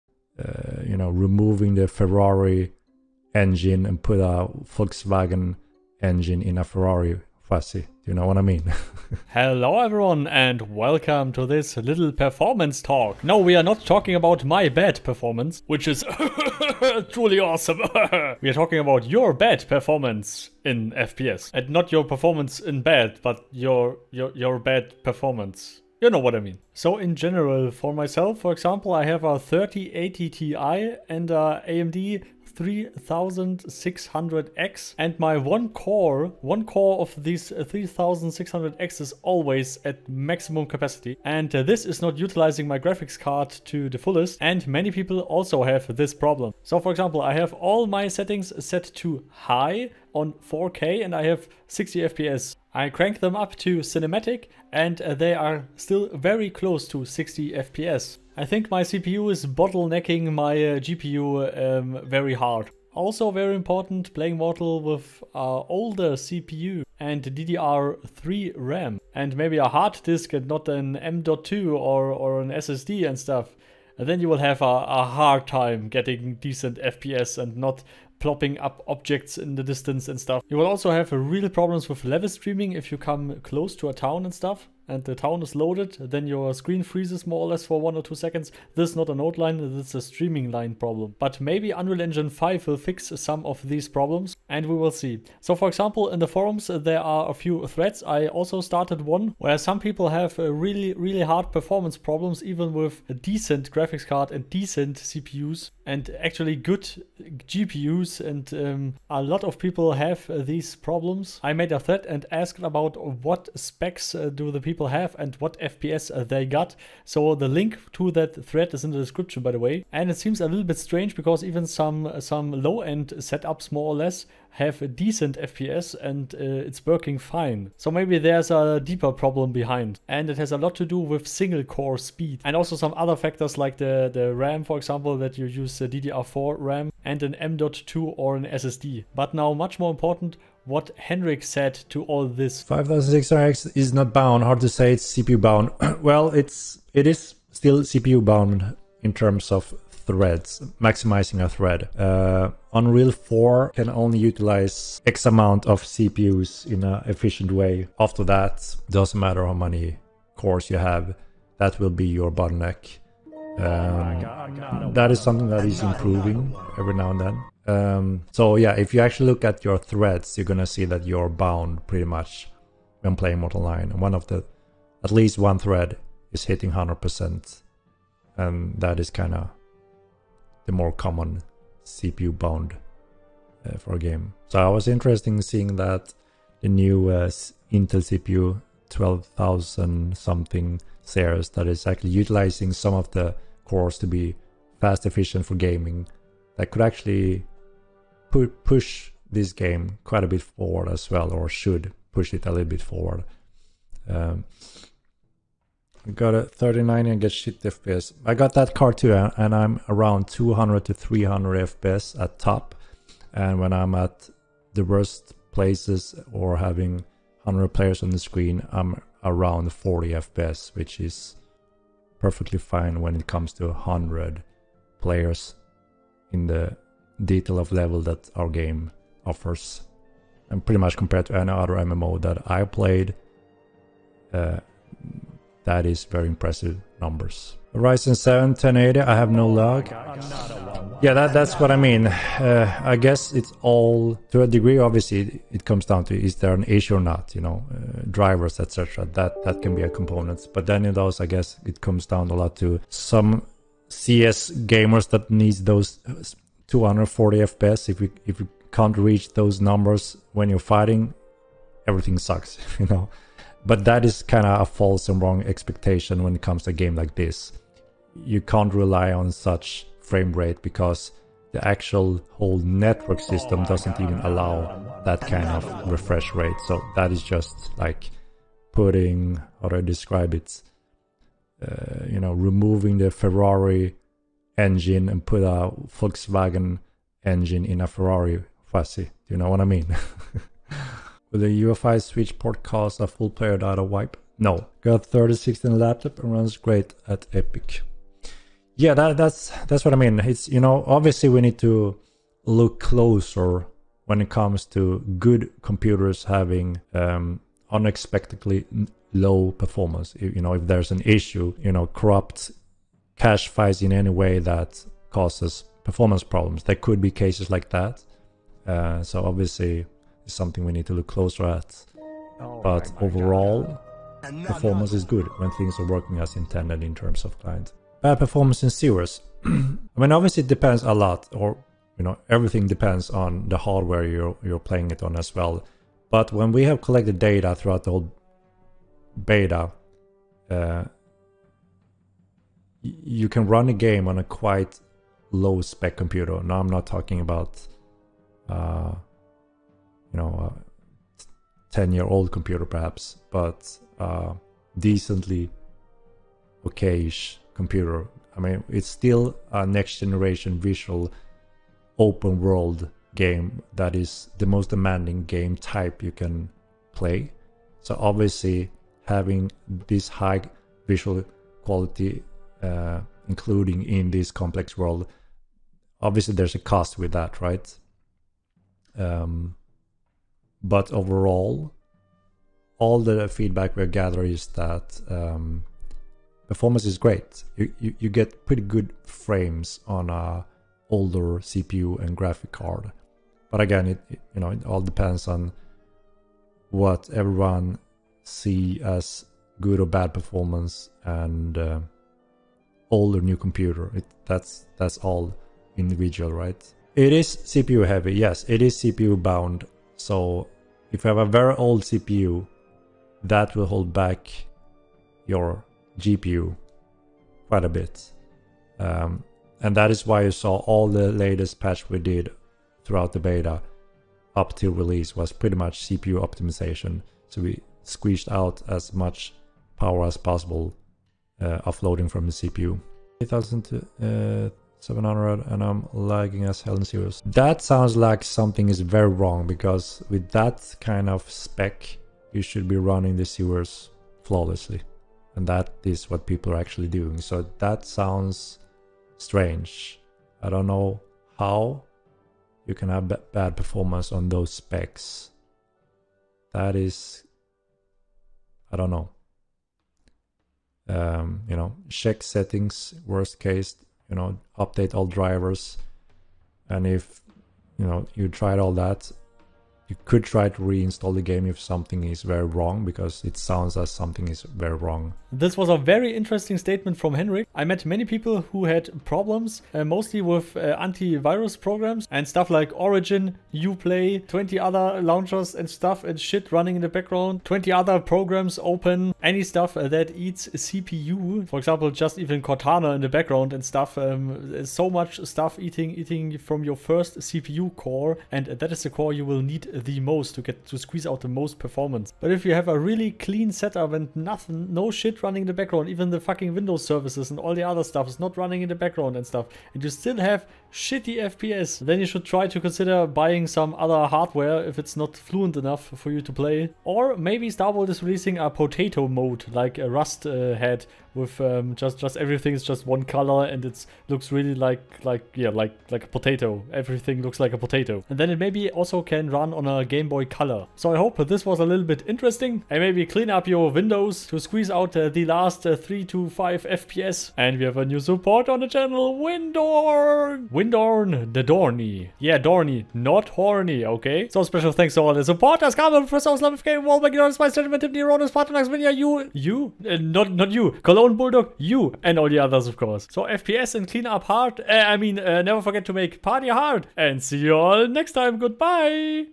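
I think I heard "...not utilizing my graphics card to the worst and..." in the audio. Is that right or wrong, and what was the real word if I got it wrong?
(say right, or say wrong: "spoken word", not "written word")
wrong: "fullest", not "worst".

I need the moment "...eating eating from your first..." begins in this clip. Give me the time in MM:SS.
08:15.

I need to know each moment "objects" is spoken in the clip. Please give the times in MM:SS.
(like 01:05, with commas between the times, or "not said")
01:18.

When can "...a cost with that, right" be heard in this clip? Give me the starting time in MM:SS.
06:16.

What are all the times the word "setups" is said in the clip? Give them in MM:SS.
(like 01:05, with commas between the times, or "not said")
02:03, 08:23.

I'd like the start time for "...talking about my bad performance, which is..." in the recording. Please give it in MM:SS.
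00:13.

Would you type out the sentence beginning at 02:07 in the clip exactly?
So maybe there's a deeper problem behind.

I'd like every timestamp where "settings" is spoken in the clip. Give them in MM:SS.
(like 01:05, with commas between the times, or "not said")
00:48, 07:42.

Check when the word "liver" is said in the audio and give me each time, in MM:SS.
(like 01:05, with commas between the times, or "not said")
not said.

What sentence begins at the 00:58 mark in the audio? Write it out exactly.
I think my CPU is bottlenecking my uh, GPU um, very hard.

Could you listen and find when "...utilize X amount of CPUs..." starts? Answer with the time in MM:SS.
02:34.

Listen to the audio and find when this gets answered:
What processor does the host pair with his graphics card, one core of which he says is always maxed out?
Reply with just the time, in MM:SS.
00:31.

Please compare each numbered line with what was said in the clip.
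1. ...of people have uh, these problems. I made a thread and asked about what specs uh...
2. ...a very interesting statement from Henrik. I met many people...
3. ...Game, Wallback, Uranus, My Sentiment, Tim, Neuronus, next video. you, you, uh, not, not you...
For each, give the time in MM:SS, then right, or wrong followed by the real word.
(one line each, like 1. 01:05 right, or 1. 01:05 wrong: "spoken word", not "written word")
1. 01:49 right
2. 07:55 right
3. 09:06 right.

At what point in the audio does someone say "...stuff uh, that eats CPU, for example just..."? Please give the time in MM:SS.
08:09.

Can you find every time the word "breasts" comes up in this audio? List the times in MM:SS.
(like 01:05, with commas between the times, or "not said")
not said.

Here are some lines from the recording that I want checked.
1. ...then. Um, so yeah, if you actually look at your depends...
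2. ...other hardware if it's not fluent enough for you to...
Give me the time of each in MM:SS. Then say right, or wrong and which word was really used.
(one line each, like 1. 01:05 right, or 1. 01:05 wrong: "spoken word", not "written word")
1. 02:47 wrong: "threads", not "depends"
2. 08:33 right.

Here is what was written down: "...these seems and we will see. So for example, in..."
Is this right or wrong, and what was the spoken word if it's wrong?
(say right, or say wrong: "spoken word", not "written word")
wrong: "problems", not "seems".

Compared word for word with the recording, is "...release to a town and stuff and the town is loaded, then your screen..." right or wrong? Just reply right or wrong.
wrong.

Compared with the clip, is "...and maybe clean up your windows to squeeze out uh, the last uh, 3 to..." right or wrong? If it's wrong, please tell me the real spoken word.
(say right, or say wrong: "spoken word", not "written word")
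right.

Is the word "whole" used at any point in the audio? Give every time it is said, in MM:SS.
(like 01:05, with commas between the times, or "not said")
04:32, 05:37.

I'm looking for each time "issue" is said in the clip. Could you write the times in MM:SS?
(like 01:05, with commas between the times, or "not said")
04:06, 05:11.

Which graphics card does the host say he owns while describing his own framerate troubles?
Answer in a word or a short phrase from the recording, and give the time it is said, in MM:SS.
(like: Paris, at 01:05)
3080 Ti, at 00:29.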